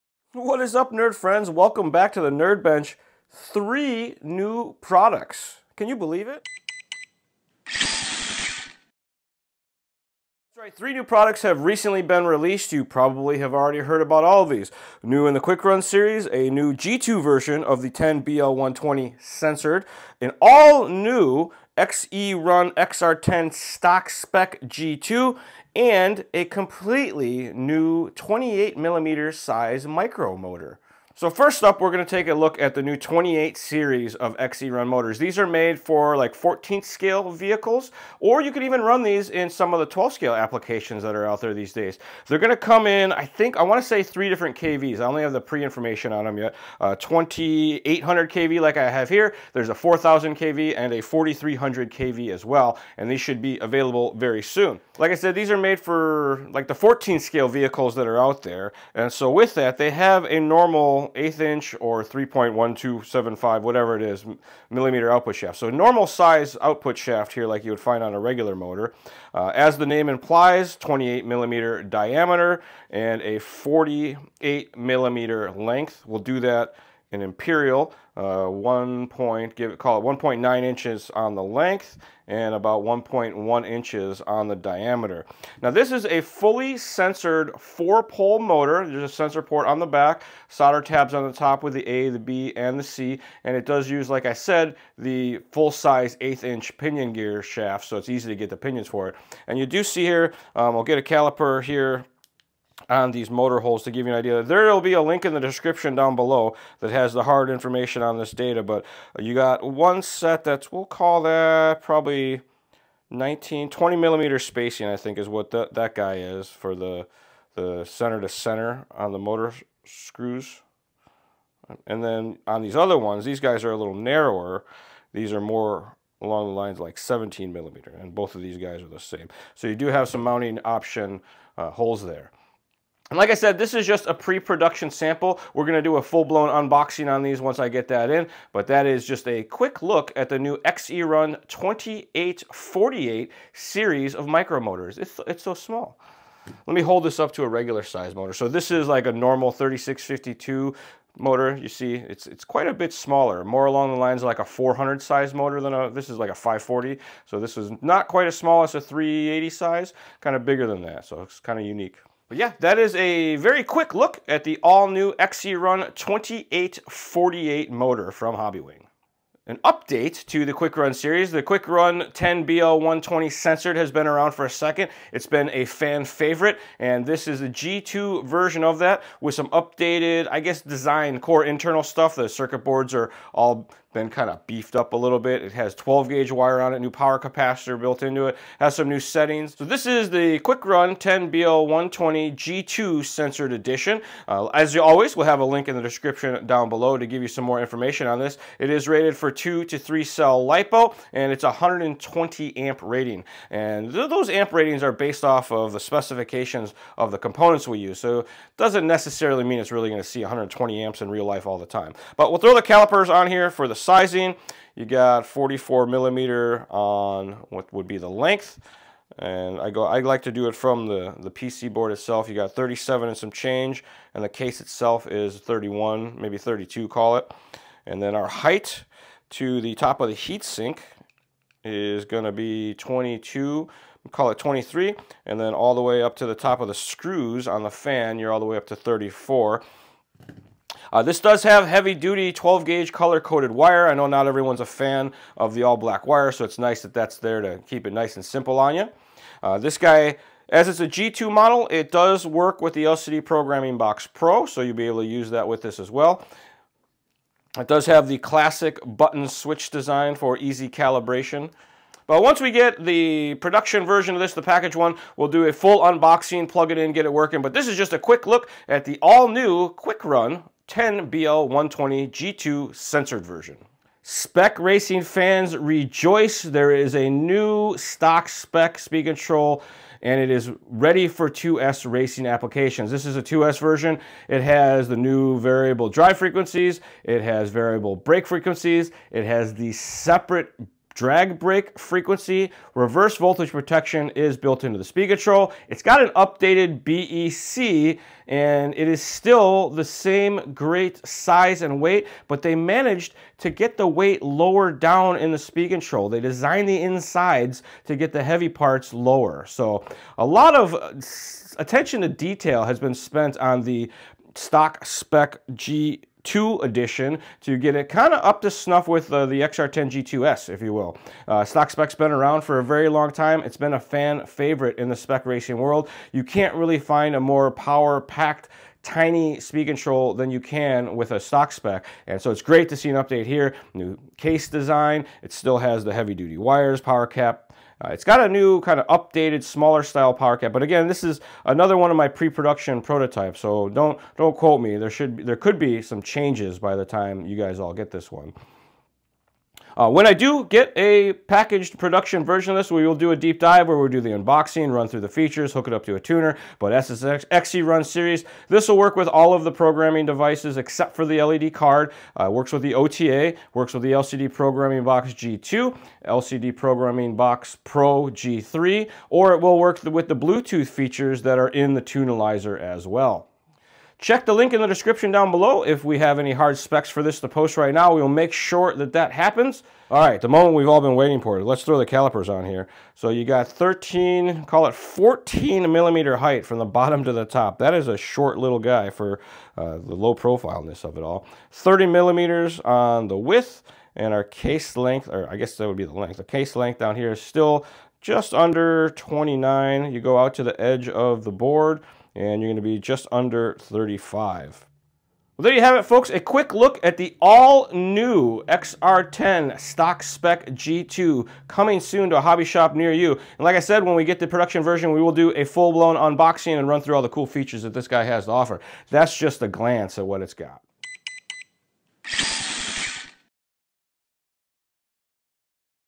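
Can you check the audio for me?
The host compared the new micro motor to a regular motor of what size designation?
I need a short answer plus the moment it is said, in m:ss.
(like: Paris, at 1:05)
3652, at 2:29.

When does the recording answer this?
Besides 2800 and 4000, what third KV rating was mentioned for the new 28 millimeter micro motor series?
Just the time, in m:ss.
0:51.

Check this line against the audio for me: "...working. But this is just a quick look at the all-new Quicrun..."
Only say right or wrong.
right.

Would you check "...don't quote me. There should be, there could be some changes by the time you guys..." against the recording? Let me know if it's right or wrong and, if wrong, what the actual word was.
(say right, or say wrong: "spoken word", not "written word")
right.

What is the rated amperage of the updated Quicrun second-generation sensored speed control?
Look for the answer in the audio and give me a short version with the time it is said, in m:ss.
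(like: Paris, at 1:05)
120 amp, at 3:21.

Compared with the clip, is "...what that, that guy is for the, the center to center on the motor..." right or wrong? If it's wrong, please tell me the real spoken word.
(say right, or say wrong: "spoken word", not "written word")
right.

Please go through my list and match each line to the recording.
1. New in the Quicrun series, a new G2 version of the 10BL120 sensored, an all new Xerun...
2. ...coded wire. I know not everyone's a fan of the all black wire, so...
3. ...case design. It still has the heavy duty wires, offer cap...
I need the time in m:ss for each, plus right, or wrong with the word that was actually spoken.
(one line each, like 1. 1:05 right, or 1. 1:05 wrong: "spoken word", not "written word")
1. 0:15 right
2. 4:03 right
3. 5:34 wrong: "power", not "offer".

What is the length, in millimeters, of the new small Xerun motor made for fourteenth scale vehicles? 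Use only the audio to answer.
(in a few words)
48 millimeter.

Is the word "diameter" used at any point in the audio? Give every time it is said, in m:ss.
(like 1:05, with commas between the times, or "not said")
1:11, 1:24.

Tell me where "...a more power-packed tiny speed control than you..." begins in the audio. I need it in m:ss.
5:27.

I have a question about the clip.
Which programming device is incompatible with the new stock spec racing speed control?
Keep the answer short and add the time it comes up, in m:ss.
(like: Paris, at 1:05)
LED card, at 6:01.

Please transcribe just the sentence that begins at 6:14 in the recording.
Check the link in the description down below if we have any hard specs for this to post right now.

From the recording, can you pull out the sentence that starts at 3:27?
So it doesn't necessarily mean it's really gonna see 120 amps in real life all the time.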